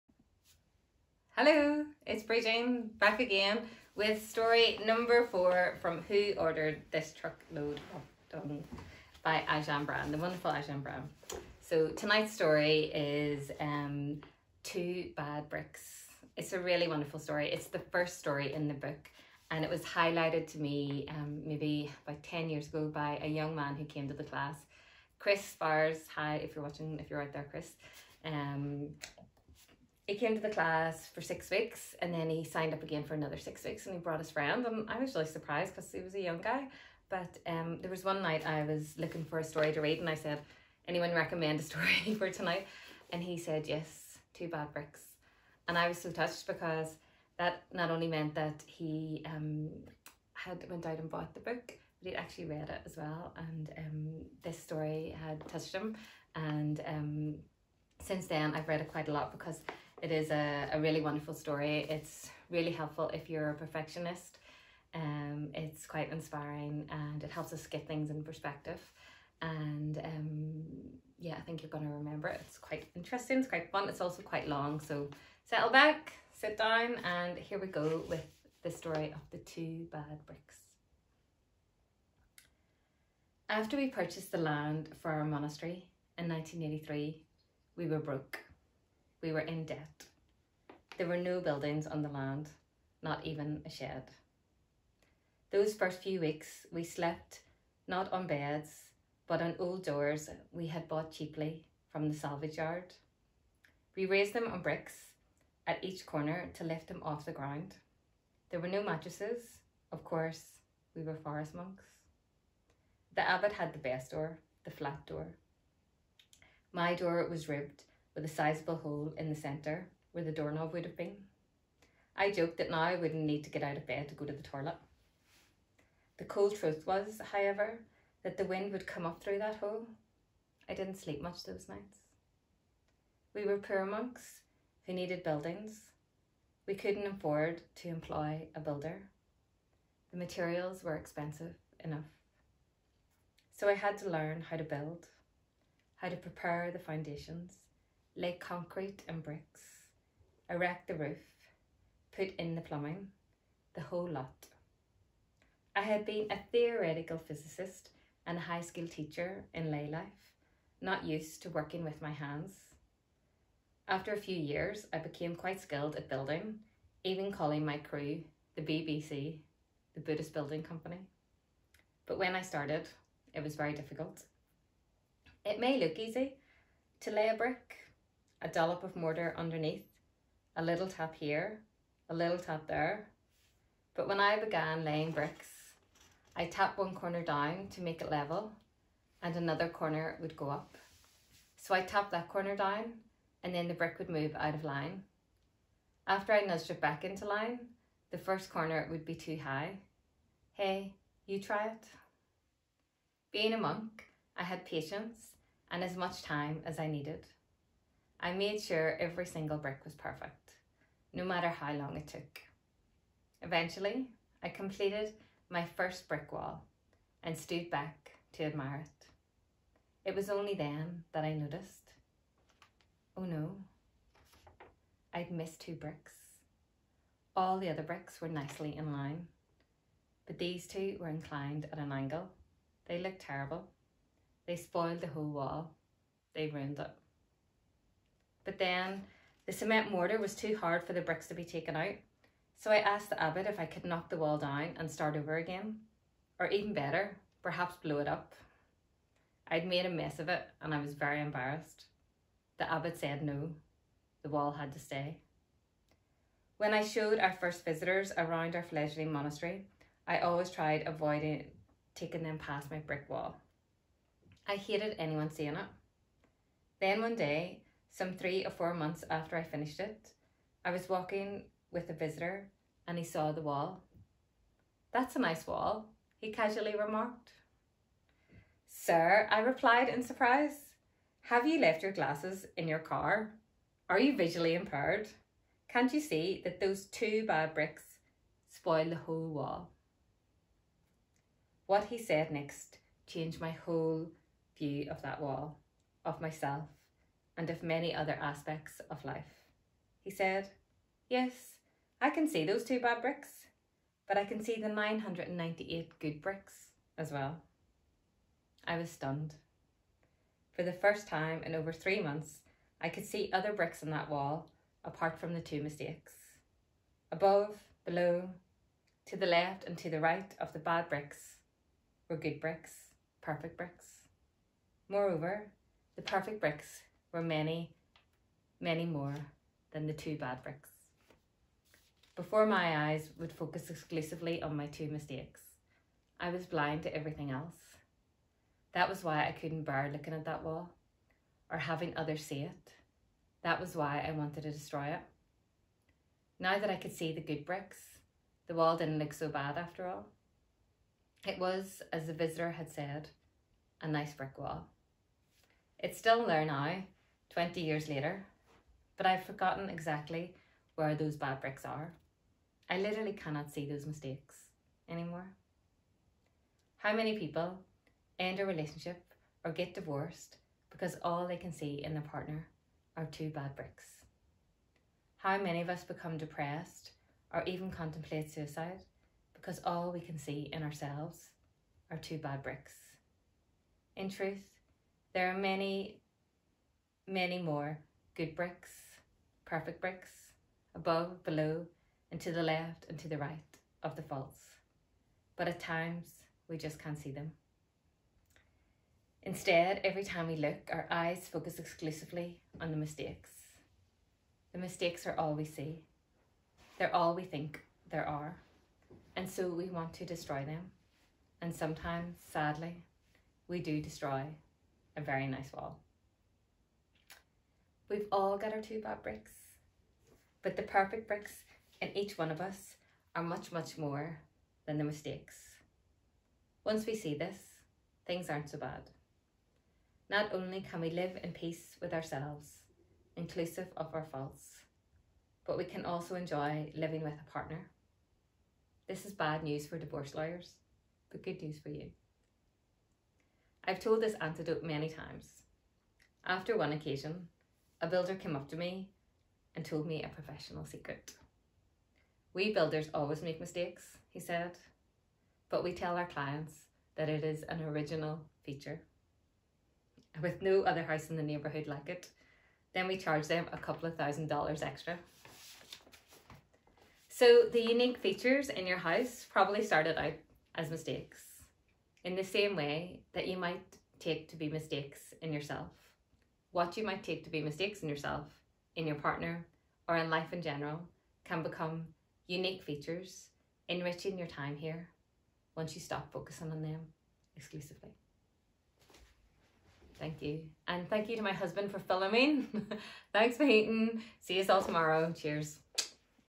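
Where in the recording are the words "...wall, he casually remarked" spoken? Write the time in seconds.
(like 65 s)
275 s.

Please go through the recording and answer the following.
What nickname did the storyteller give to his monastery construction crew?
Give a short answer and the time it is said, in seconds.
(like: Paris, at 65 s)
Buddhist Building Company, at 170 s.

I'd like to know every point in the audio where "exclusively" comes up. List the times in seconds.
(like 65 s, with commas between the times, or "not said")
333 s, 401 s, 487 s.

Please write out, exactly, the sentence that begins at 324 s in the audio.
Moreover, the perfect bricks were many, many more than the two bad bricks.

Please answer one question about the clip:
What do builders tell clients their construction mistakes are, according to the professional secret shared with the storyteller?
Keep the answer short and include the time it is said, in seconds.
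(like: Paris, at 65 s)
an original feature, at 457 s.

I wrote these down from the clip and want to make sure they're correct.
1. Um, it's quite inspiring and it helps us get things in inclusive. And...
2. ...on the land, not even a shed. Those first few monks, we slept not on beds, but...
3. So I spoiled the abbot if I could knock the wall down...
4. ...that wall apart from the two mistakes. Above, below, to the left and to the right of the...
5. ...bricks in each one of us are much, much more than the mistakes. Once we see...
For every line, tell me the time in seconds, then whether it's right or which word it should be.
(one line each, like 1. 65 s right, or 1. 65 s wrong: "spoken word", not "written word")
1. 64 s wrong: "perspective", not "inclusive"
2. 91 s wrong: "weeks", not "monks"
3. 242 s wrong: "asked", not "spoiled"
4. 313 s right
5. 421 s right.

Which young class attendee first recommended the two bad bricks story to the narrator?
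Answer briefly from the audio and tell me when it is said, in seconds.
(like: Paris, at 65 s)
Chris Spars, at 25 s.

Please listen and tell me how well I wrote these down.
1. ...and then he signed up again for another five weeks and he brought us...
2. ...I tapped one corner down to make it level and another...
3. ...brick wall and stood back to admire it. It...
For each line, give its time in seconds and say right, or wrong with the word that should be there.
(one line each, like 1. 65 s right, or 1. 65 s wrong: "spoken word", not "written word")
1. 32 s wrong: "six", not "five"
2. 186 s right
3. 216 s right.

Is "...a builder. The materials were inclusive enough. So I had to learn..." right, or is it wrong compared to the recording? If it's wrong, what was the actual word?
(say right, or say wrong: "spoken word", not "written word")
wrong: "expensive", not "inclusive".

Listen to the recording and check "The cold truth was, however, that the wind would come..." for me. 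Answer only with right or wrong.
right.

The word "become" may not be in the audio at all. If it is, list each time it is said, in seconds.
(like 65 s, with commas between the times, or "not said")
375 s, 481 s.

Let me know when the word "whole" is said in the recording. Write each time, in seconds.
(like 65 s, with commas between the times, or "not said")
153 s, 235 s, 288 s, 293 s.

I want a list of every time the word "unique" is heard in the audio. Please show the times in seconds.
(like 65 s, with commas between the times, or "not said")
467 s, 482 s.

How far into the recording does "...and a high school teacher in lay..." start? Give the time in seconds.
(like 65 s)
158 s.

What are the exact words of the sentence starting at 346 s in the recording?
Now that I could see the good bricks, the wall didn't look so bad after all.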